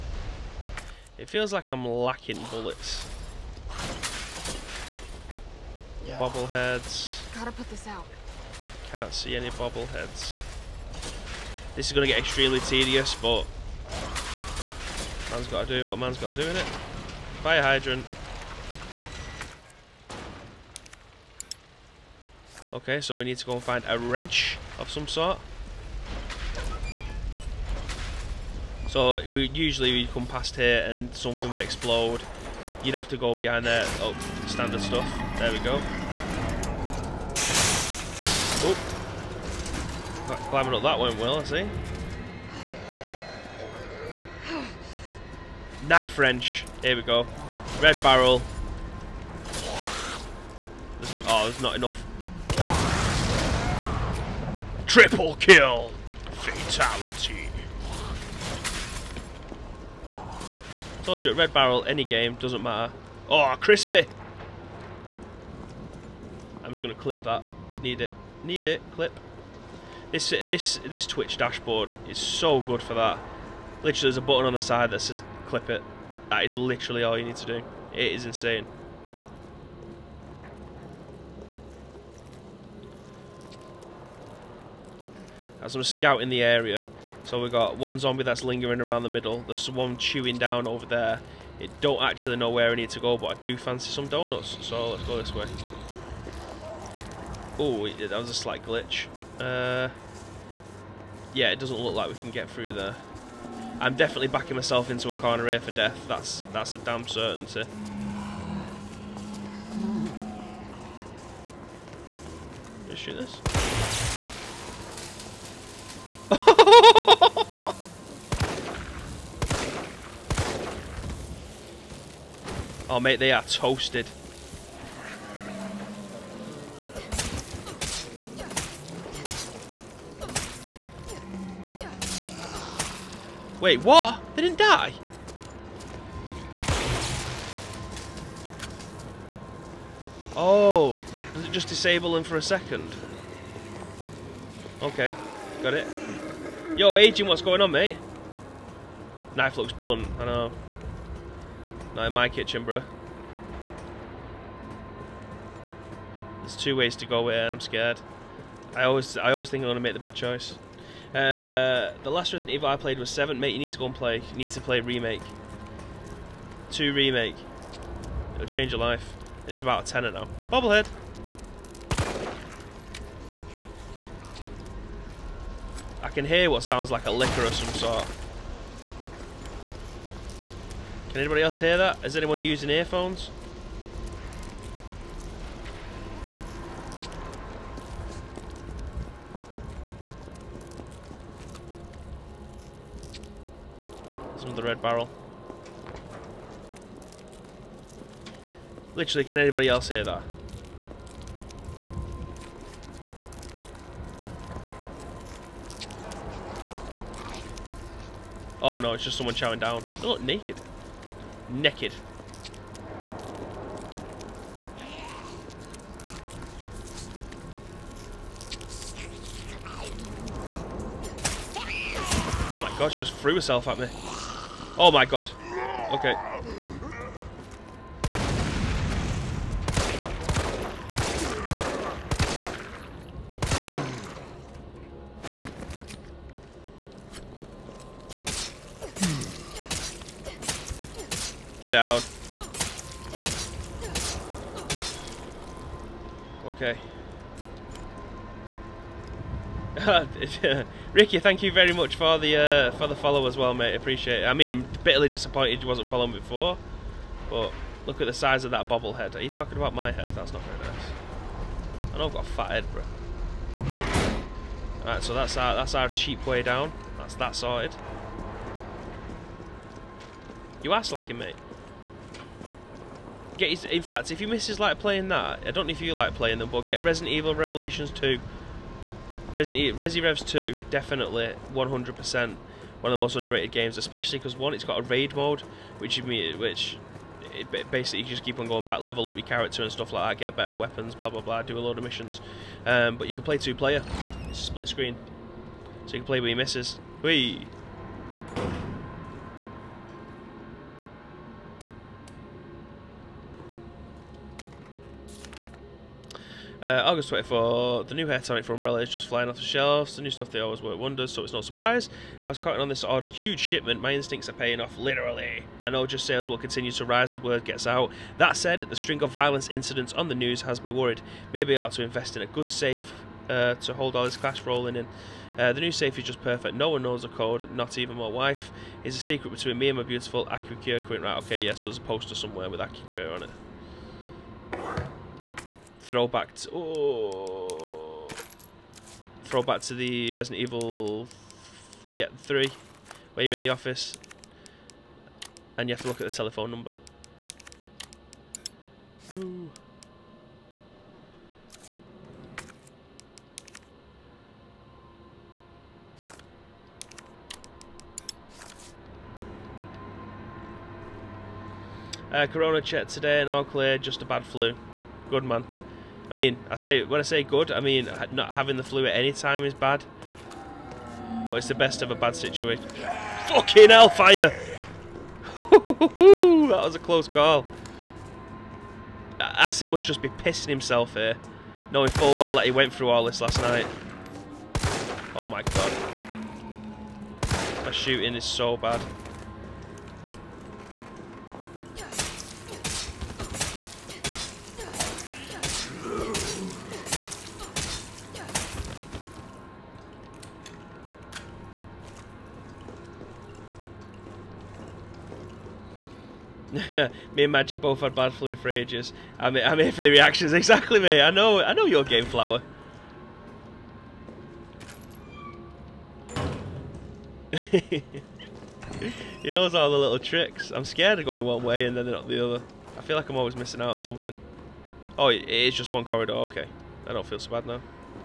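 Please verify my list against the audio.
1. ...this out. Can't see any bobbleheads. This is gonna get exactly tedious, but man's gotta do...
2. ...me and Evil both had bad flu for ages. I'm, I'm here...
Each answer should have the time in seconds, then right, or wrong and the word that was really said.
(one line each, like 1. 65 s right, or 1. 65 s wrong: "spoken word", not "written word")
1. 7 s wrong: "extremely", not "exactly"
2. 406 s wrong: "Magic", not "Evil".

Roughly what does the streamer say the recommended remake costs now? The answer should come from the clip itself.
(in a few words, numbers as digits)
A tenner.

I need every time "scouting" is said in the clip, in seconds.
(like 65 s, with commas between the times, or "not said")
85 s.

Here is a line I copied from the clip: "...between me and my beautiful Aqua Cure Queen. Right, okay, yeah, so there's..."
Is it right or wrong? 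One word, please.
right.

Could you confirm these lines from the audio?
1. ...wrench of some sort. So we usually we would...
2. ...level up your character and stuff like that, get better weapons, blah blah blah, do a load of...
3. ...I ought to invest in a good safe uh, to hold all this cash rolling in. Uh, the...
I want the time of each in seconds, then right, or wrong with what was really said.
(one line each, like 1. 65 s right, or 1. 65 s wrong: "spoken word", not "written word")
1. 23 s right
2. 288 s right
3. 321 s right.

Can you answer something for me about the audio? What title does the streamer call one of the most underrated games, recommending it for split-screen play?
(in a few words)
Resident Evil Revelations 2.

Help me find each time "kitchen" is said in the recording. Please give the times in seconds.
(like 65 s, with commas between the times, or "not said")
152 s.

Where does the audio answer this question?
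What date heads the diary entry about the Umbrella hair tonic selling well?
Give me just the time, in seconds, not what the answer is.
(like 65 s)
306 s.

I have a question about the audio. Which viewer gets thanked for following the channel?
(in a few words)
Ricky.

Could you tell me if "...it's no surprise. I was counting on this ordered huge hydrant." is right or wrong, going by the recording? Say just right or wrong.
wrong.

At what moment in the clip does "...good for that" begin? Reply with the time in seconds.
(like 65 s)
72 s.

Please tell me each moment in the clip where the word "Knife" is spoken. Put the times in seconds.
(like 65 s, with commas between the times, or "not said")
45 s, 149 s.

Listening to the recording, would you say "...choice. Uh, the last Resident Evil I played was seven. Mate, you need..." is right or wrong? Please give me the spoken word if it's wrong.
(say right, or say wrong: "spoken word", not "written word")
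right.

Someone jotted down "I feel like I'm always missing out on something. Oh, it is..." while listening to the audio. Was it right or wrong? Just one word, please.
right.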